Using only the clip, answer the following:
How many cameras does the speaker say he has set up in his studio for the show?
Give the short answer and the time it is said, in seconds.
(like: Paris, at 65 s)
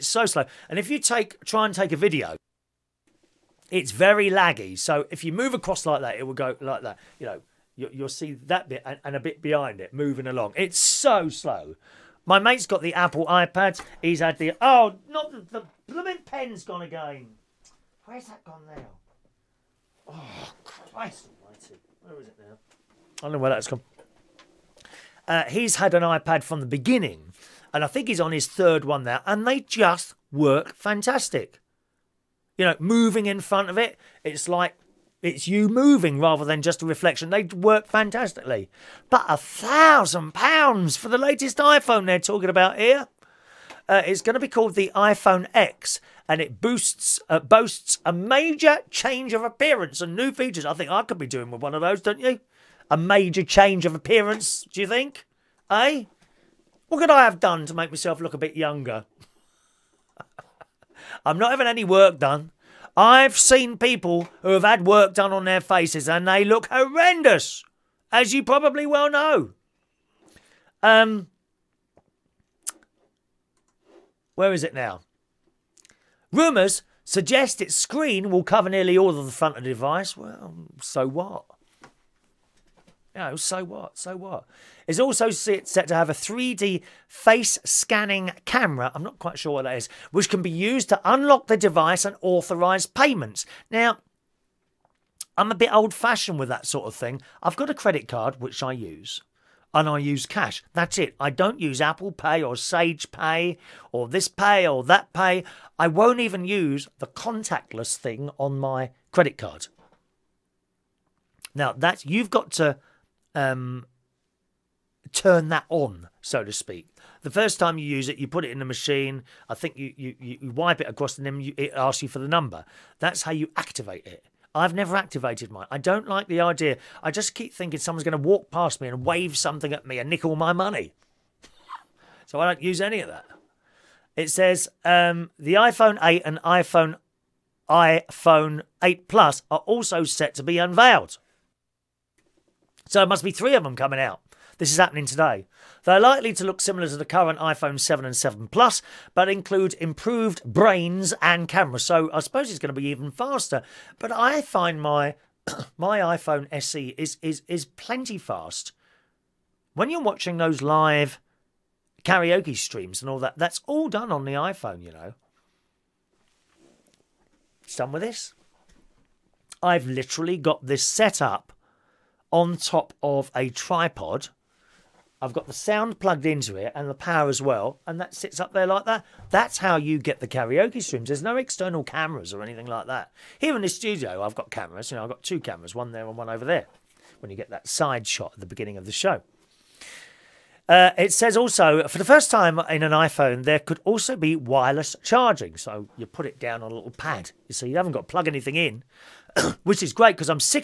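2, at 185 s.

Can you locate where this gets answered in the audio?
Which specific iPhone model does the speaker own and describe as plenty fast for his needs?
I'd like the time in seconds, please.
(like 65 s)
155 s.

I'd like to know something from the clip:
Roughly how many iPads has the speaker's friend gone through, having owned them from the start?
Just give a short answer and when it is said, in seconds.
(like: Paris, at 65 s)
3, at 28 s.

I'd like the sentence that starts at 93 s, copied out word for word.
Now, I'm a bit old fashioned with that sort of thing.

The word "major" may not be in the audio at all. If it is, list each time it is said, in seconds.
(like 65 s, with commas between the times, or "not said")
48 s, 52 s.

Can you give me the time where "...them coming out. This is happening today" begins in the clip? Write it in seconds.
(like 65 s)
143 s.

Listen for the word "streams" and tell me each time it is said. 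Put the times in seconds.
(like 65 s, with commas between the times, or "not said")
162 s, 180 s.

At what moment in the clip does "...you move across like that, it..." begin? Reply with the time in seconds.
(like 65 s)
5 s.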